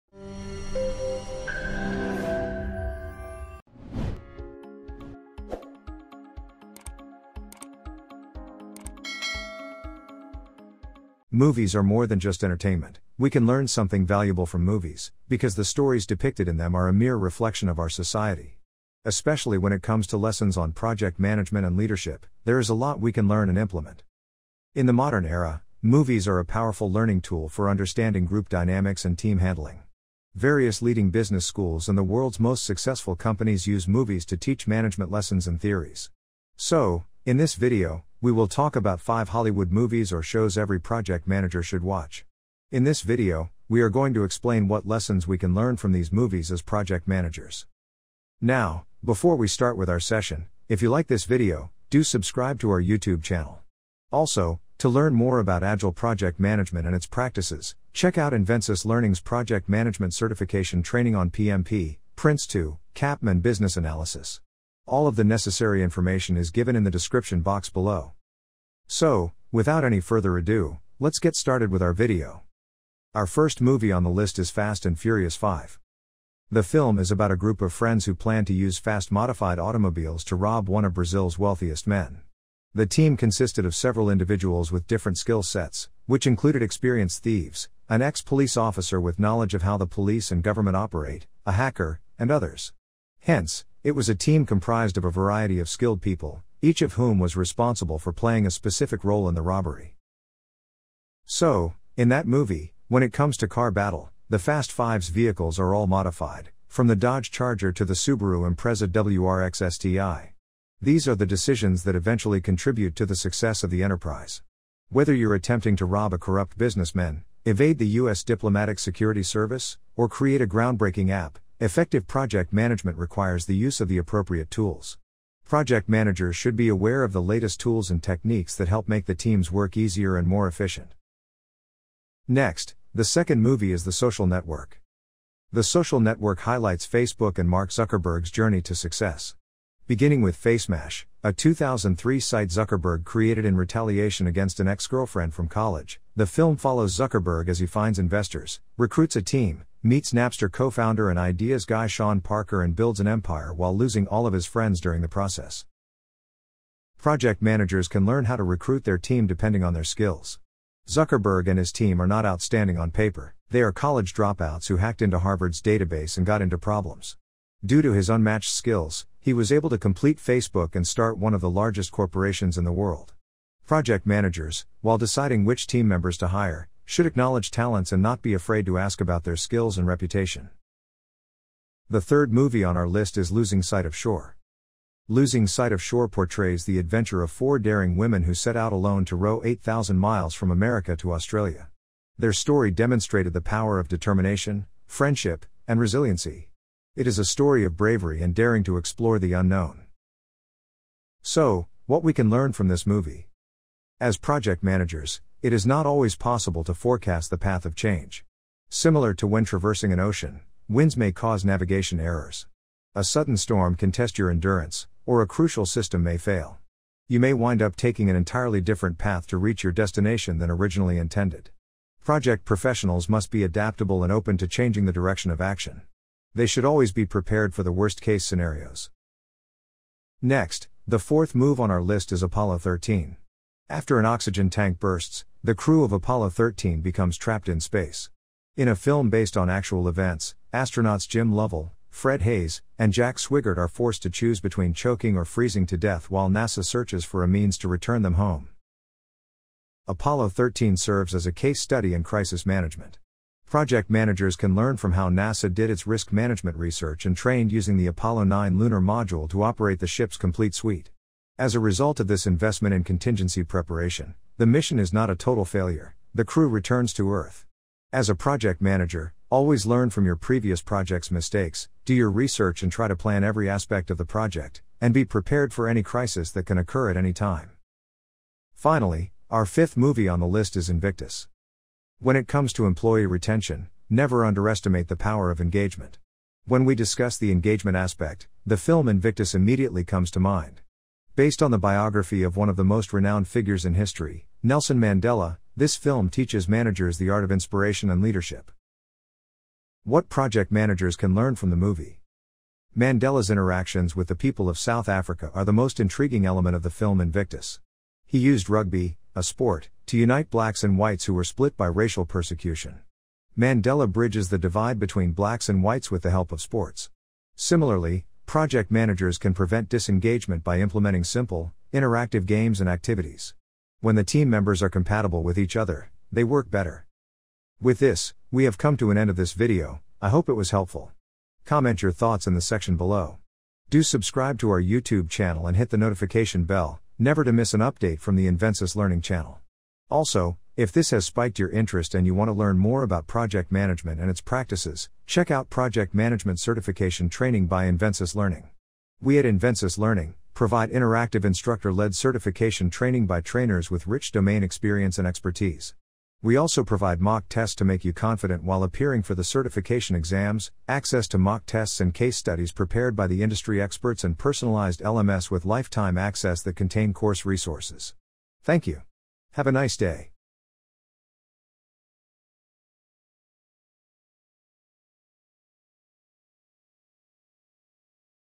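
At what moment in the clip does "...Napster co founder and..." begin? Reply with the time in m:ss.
2:30.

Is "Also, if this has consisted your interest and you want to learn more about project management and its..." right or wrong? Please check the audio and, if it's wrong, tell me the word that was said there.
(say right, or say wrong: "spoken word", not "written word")
wrong: "spiked", not "consisted".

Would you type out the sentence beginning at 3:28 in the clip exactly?
Similar to when traversing an ocean, winds may cause navigation errors.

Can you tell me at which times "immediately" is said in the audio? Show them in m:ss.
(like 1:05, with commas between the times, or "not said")
4:49.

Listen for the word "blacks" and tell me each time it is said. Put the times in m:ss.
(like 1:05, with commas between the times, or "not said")
5:10, 5:15.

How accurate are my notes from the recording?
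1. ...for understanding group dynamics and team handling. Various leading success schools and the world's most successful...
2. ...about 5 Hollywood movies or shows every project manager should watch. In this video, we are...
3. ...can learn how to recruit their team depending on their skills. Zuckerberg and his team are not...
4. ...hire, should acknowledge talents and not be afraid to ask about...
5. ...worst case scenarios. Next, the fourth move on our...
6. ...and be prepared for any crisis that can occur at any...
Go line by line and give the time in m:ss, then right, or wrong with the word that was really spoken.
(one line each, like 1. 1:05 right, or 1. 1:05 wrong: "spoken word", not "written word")
1. 0:27 wrong: "business", not "success"
2. 0:38 right
3. 2:37 right
4. 2:56 right
5. 3:47 right
6. 4:34 right.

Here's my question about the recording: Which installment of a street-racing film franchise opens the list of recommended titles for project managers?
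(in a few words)
Fast and Furious 5.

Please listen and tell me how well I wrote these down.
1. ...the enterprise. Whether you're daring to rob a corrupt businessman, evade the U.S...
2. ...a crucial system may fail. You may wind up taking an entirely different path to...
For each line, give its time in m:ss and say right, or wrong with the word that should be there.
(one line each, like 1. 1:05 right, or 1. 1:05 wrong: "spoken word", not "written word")
1. 1:53 wrong: "attempting", not "daring"
2. 3:35 right.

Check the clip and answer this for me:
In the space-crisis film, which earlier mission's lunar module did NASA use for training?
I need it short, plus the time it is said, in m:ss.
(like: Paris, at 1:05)
Apollo 9, at 4:17.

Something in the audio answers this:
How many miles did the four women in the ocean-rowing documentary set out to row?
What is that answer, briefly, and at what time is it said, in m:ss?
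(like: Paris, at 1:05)
8,000, at 3:09.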